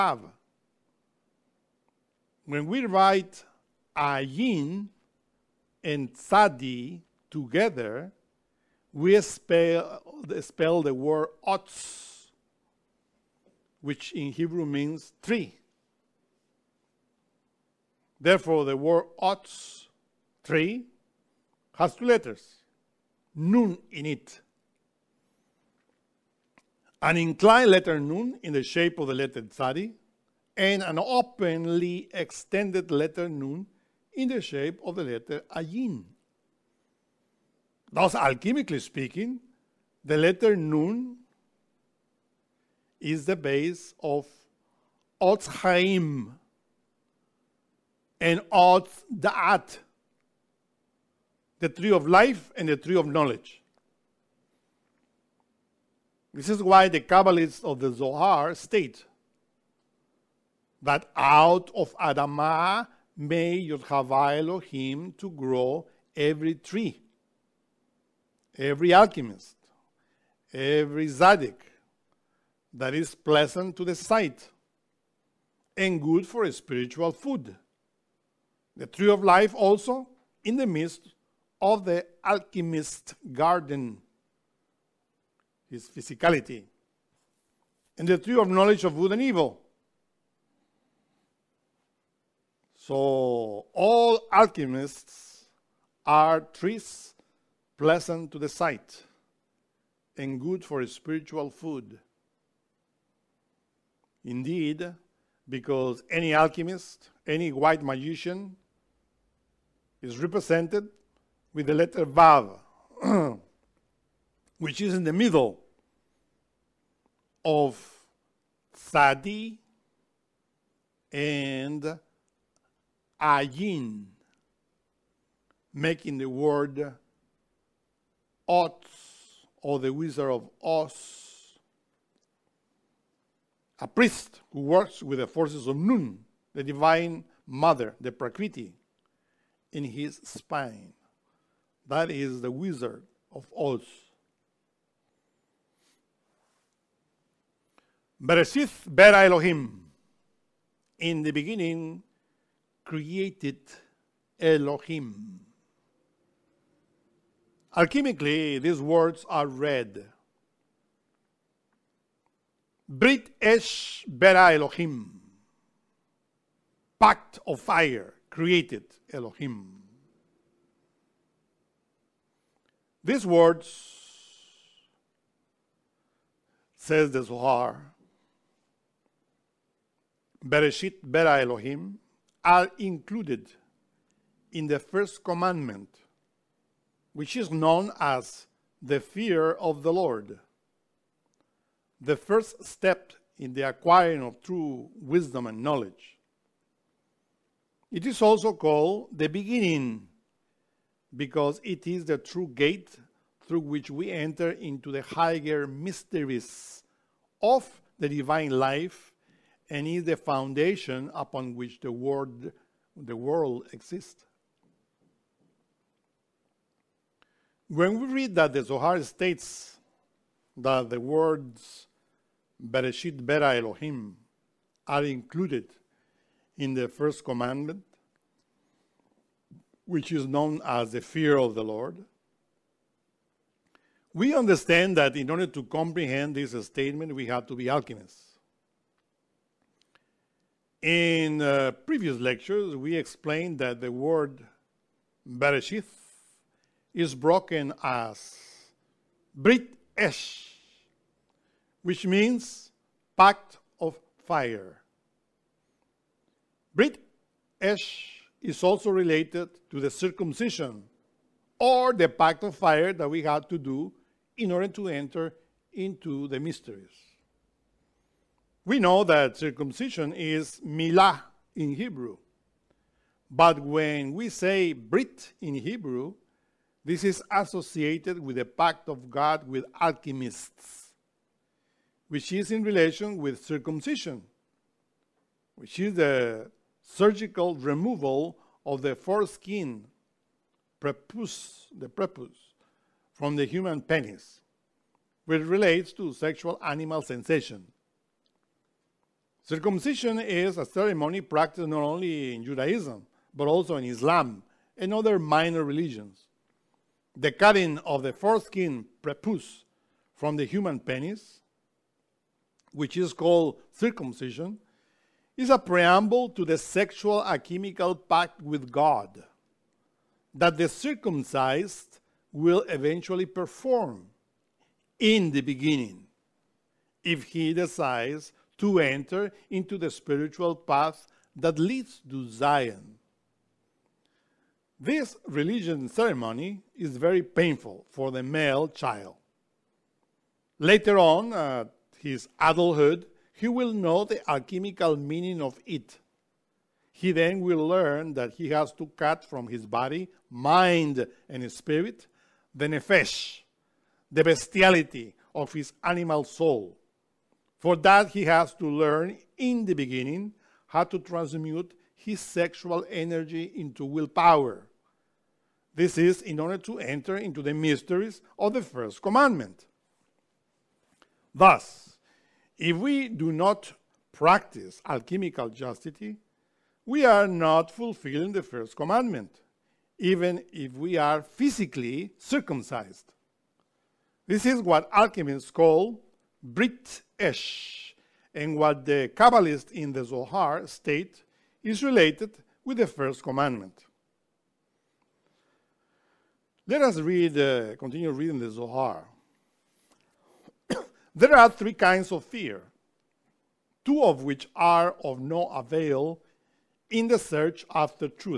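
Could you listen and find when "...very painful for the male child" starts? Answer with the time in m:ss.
5:36.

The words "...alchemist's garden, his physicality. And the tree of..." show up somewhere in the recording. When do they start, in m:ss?
1:22.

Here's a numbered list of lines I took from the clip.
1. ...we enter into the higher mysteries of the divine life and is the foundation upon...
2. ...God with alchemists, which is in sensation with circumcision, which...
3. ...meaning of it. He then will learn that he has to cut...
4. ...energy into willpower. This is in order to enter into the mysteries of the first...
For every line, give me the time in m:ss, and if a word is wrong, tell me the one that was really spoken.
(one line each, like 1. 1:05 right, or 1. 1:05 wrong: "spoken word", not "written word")
1. 3:23 right
2. 4:39 wrong: "relation", not "sensation"
3. 5:44 right
4. 6:02 right.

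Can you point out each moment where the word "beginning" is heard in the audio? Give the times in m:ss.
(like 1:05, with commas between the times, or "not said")
2:31, 3:19, 5:25, 5:59.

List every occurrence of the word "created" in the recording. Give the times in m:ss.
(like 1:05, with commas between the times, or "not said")
2:32, 2:48.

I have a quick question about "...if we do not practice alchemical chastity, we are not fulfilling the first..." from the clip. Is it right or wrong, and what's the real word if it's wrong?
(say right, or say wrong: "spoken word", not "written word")
right.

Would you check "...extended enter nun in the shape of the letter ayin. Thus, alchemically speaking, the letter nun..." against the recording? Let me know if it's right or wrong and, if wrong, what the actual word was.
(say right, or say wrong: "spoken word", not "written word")
wrong: "letter", not "enter".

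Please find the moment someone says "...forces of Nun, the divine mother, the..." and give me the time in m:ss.
2:15.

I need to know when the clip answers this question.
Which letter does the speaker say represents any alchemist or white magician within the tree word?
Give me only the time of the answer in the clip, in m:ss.
1:52.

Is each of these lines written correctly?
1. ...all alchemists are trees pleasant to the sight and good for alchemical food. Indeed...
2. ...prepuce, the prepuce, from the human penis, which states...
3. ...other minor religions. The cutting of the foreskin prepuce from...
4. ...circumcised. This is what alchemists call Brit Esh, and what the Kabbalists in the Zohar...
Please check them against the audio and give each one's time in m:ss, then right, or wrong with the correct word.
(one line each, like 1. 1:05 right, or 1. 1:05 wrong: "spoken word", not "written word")
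1. 1:33 wrong: "spiritual", not "alchemical"
2. 4:50 wrong: "relates", not "states"
3. 5:04 right
4. 6:22 right.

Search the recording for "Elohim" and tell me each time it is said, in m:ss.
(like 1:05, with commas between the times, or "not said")
1:04, 2:29, 2:34, 2:44, 2:49, 3:01, 3:43.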